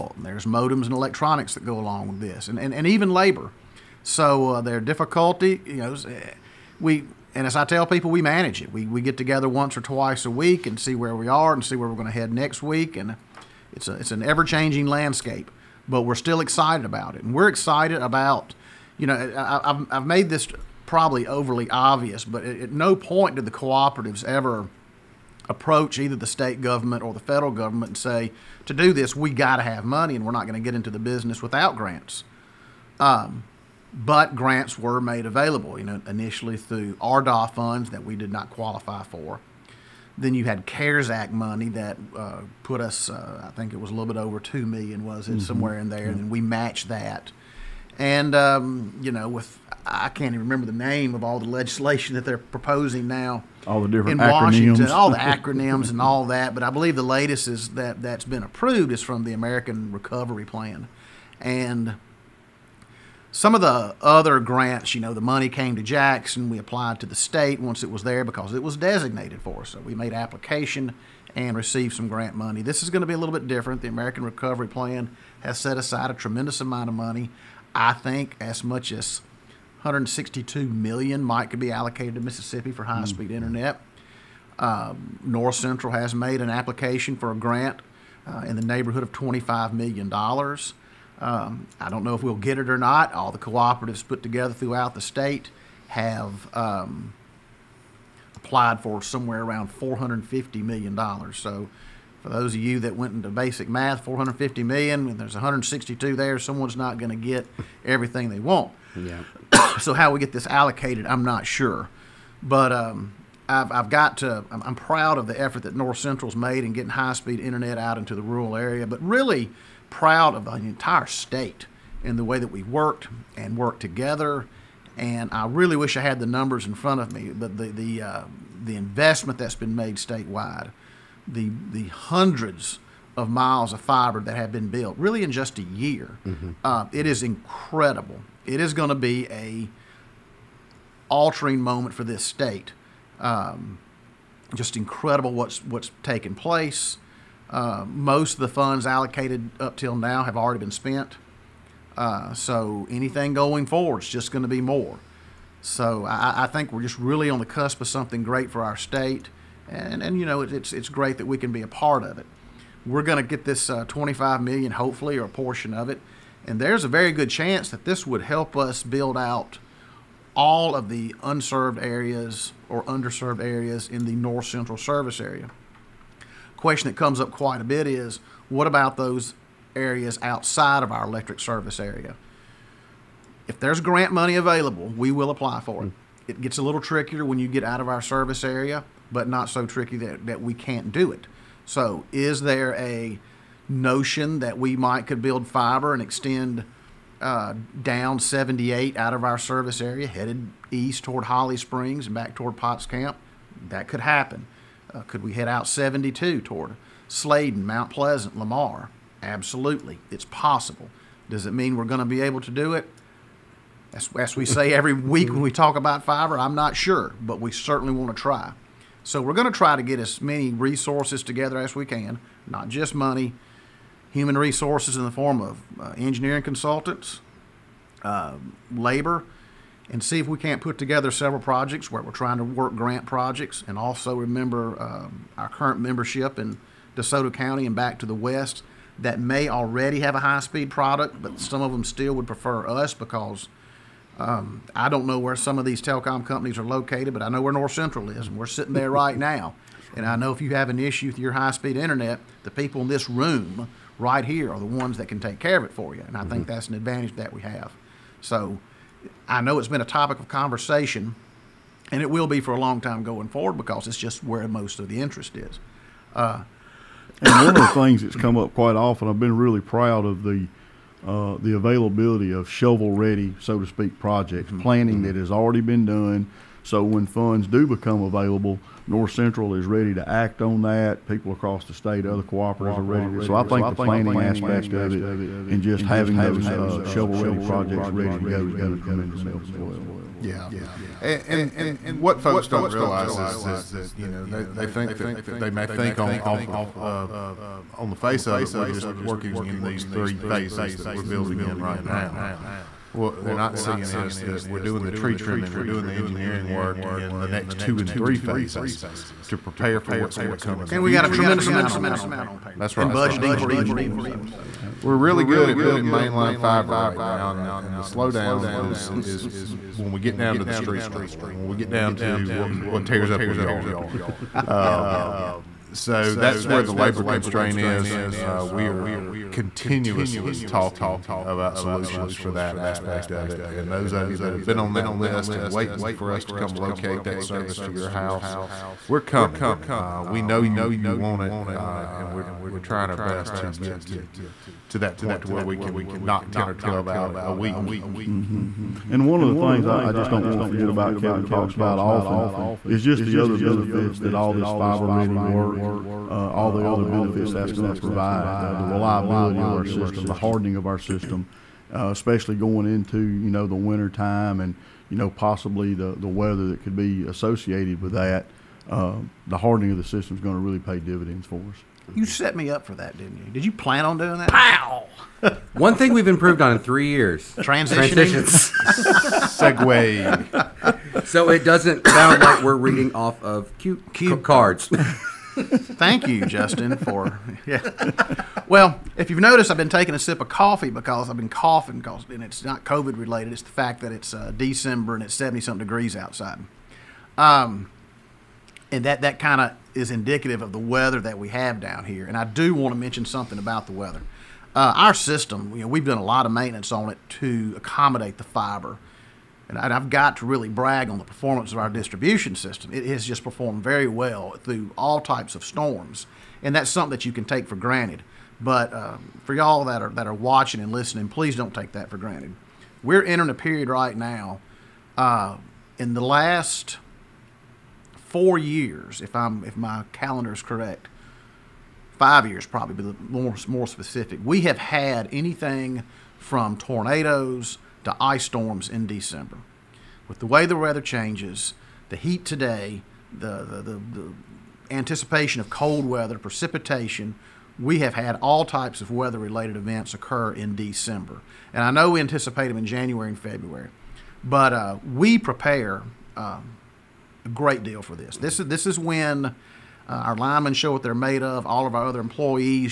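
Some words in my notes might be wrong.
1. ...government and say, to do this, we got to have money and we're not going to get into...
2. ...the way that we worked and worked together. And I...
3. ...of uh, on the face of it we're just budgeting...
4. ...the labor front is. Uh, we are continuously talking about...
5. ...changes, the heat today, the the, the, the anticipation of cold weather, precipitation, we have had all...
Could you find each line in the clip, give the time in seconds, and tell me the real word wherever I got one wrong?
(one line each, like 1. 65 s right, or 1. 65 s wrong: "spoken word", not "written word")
1. 27 s right
2. 122 s right
3. 296 s wrong: "working", not "budgeting"
4. 326 s wrong: "constraint", not "front"
5. 440 s right.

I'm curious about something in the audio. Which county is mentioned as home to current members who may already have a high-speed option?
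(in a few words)
DeSoto County.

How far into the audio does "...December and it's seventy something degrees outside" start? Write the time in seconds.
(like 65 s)
394 s.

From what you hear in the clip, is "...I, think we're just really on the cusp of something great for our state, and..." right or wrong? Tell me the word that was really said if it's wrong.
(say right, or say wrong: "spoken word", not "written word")
right.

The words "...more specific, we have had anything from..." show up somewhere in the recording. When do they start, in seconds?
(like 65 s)
433 s.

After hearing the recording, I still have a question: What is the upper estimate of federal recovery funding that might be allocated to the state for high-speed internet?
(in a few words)
162 million.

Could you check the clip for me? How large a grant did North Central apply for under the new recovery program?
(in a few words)
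25 million dollars.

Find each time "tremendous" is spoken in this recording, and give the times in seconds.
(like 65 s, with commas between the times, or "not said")
76 s, 288 s, 311 s.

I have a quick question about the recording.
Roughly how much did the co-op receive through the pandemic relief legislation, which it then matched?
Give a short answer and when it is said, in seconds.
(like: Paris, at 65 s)
2 million, at 43 s.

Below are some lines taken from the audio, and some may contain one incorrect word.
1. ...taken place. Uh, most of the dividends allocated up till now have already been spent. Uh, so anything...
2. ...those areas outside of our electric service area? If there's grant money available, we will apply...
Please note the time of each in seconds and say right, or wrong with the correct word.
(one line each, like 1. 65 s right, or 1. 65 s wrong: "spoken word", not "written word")
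1. 146 s wrong: "funds", not "dividends"
2. 178 s right.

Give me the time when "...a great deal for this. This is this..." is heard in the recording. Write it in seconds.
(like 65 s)
457 s.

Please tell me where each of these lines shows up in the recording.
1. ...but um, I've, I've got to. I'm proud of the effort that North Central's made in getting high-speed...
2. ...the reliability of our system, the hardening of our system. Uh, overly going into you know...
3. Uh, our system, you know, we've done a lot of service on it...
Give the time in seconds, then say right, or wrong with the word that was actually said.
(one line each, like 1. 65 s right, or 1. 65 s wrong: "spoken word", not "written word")
1. 112 s right
2. 358 s wrong: "especially", not "overly"
3. 404 s wrong: "maintenance", not "service".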